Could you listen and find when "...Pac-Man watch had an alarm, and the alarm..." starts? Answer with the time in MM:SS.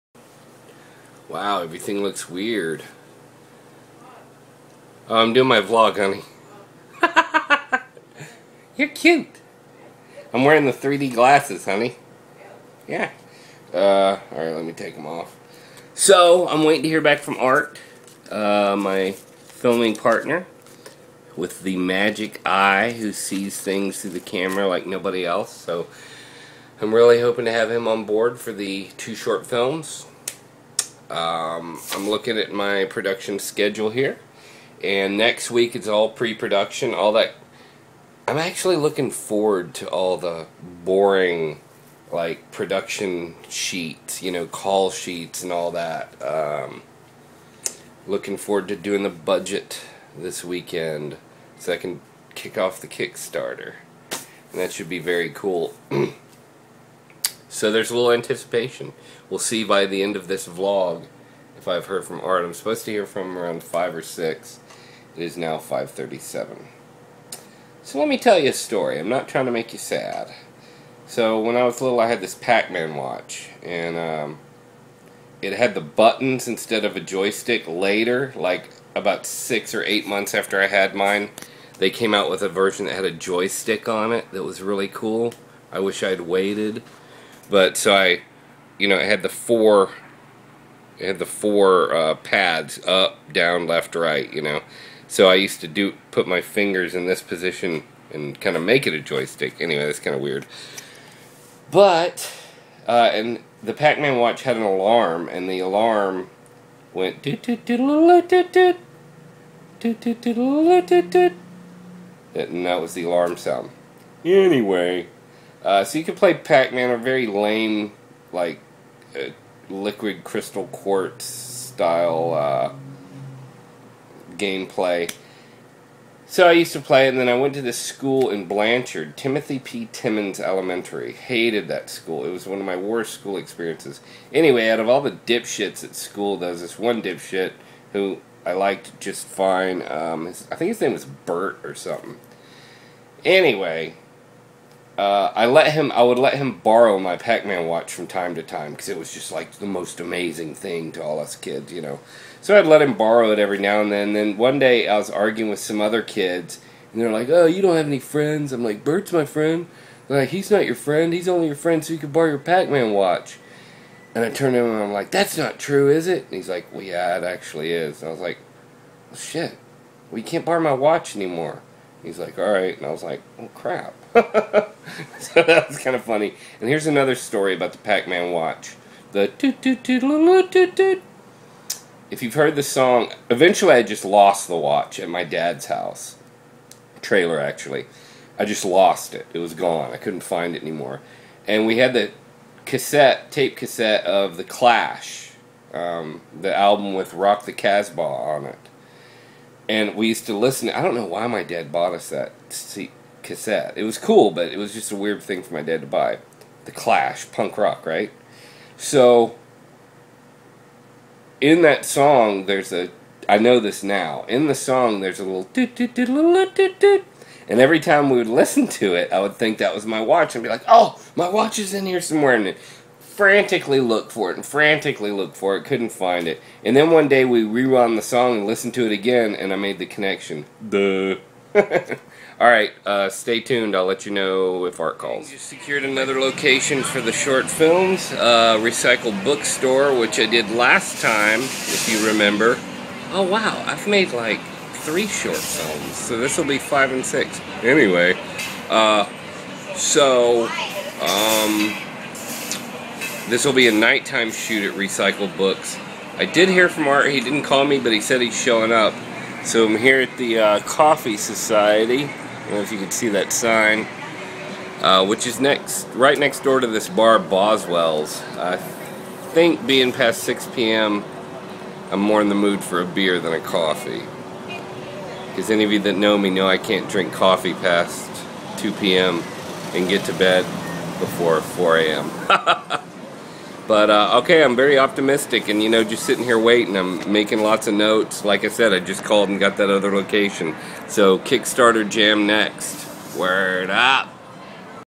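01:43.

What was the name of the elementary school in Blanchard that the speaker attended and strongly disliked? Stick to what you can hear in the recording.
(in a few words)
Timothy P. Timmons Elementary.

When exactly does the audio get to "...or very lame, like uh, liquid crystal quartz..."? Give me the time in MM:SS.
01:56.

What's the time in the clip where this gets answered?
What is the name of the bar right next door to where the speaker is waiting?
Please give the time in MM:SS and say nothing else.
04:27.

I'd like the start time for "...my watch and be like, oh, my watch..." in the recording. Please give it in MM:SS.
03:39.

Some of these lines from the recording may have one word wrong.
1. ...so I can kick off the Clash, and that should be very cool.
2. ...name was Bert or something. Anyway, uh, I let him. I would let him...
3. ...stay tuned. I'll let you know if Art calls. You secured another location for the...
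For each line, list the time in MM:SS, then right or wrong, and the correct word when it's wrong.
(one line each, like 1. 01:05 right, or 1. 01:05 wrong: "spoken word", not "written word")
1. 00:51 wrong: "Kickstarter", not "Clash"
2. 02:20 right
3. 03:53 right.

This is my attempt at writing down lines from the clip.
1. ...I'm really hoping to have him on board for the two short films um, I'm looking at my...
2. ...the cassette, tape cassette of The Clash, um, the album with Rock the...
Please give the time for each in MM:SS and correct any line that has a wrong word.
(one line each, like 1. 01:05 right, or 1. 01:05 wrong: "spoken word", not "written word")
1. 00:26 right
2. 03:11 right.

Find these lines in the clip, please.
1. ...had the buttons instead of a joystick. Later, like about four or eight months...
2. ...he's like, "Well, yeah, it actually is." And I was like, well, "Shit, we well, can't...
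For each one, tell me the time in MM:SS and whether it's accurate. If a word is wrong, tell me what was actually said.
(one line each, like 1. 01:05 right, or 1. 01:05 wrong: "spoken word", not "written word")
1. 01:15 wrong: "six", not "four"
2. 02:46 right.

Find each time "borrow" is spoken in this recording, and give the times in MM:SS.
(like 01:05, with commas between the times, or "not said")
02:26, 02:32, 02:42, 02:50.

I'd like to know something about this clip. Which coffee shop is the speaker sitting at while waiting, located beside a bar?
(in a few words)
Coffee Society.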